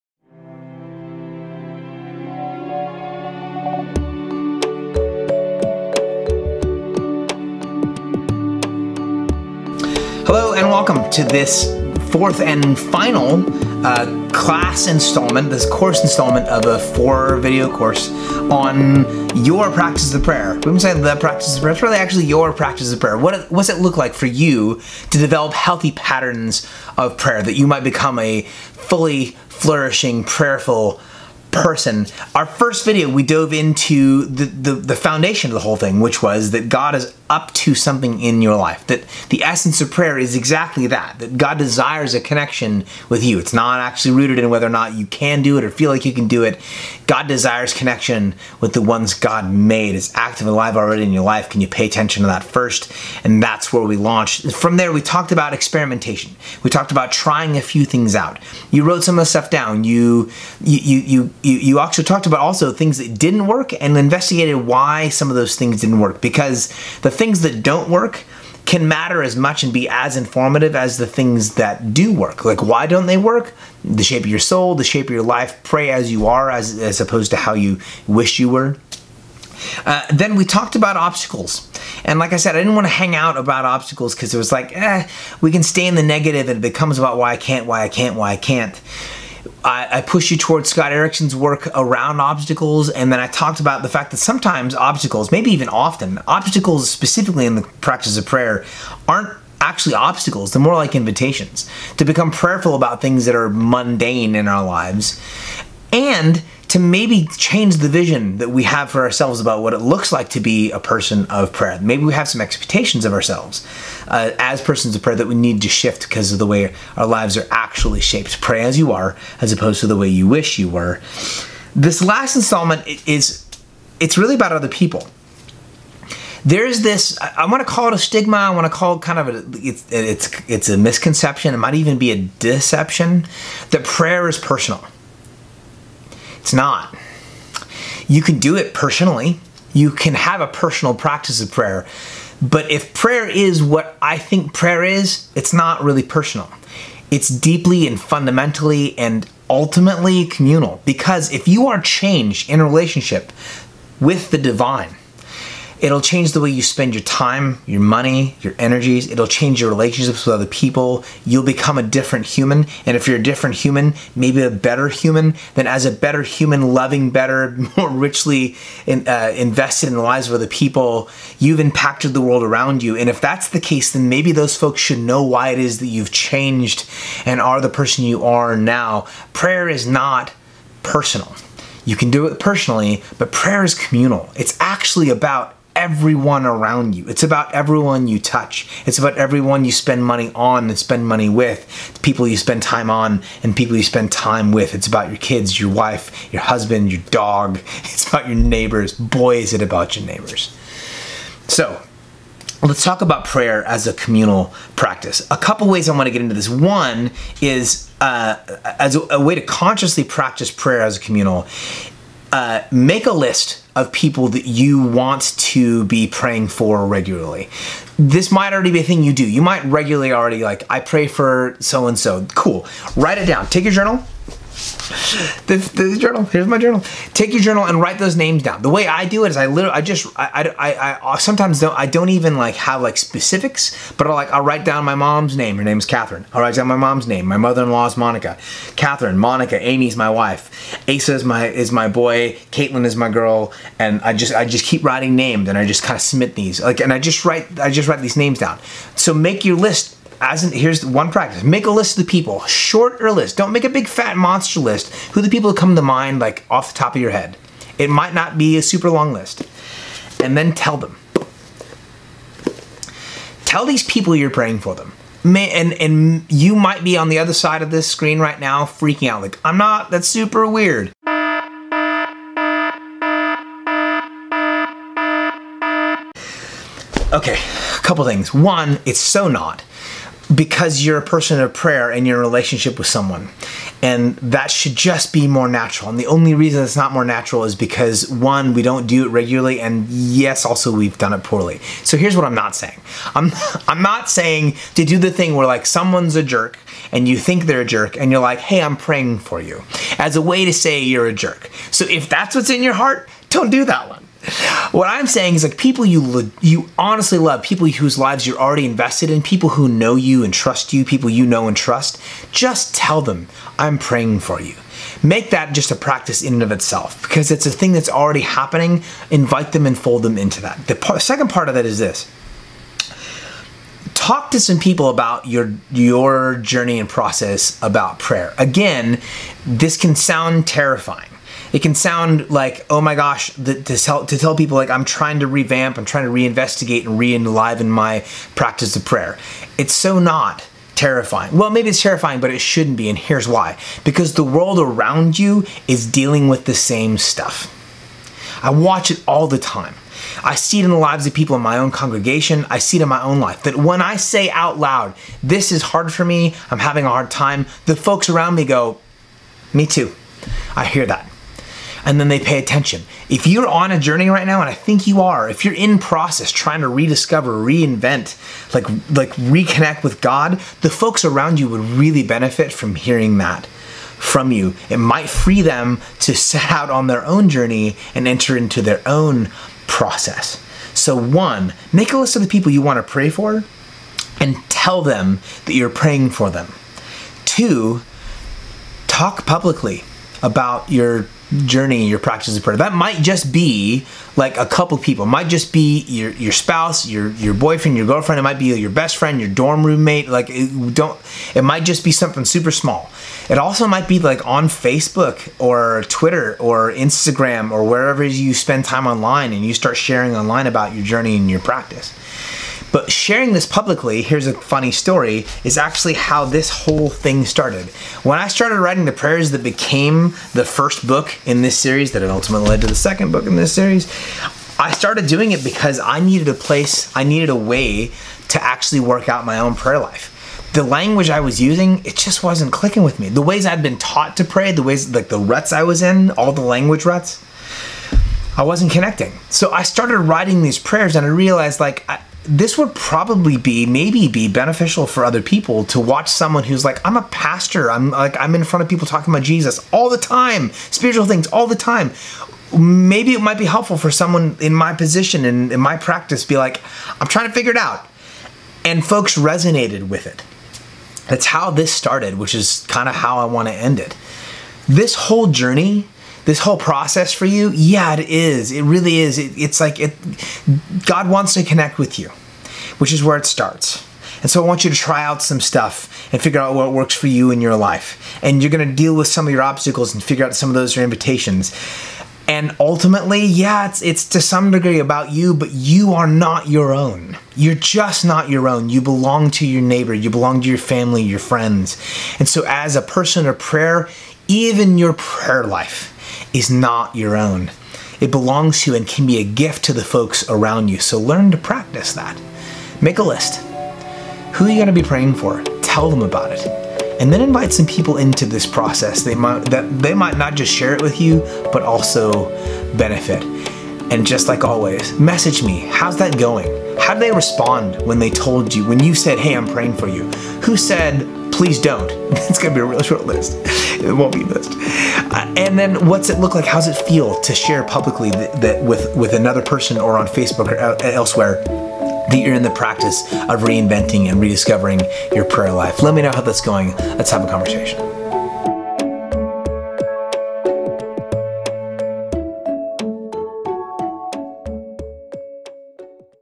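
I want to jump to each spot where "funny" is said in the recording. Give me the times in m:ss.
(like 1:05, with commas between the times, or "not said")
6:54.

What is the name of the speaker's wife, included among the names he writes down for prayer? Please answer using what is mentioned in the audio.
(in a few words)
Amy.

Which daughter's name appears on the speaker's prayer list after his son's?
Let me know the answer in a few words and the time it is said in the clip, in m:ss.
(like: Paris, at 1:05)
Caitlin, at 4:02.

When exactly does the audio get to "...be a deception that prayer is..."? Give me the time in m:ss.
2:11.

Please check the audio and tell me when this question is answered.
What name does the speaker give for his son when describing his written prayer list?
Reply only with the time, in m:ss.
4:00.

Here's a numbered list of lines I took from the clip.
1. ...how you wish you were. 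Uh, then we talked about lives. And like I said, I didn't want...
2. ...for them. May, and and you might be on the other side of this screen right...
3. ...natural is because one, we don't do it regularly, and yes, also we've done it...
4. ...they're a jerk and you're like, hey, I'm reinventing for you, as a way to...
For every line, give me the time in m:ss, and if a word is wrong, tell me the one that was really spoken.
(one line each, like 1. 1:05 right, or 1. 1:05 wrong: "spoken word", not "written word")
1. 1:17 wrong: "obstacles", not "lives"
2. 4:24 right
3. 4:47 right
4. 4:57 wrong: "praying", not "reinventing".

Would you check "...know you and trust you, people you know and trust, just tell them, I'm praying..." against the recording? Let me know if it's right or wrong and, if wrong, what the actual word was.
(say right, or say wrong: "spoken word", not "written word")
right.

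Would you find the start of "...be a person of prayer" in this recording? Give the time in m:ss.
1:50.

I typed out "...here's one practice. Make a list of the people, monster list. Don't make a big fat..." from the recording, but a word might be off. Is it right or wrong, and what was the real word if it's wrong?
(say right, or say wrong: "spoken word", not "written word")
wrong: "shorter", not "monster".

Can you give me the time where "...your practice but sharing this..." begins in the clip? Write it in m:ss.
6:51.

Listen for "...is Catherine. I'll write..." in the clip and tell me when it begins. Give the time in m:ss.
3:55.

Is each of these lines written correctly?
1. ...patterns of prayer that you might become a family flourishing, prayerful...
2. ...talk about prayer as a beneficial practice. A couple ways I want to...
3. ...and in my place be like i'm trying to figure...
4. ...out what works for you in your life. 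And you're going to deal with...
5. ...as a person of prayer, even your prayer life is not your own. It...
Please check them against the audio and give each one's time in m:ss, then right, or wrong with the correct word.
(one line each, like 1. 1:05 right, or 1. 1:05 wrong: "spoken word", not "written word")
1. 0:25 wrong: "fully", not "family"
2. 3:22 wrong: "communal", not "beneficial"
3. 7:35 wrong: "practice", not "place"
4. 7:56 right
5. 8:12 right.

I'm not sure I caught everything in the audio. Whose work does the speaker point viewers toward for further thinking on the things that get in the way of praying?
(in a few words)
Scott Erickson.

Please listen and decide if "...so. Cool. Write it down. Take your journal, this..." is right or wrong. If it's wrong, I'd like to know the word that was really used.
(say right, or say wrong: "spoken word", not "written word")
right.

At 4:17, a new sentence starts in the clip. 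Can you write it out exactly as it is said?
It might not be a super long list.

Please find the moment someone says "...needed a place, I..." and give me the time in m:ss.
7:05.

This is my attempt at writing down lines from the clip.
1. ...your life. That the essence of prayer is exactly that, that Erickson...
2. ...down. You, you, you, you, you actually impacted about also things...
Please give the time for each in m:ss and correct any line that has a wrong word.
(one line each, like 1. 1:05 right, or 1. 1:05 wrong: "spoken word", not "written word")
1. 0:38 wrong: "God", not "Erickson"
2. 0:59 wrong: "talked", not "impacted".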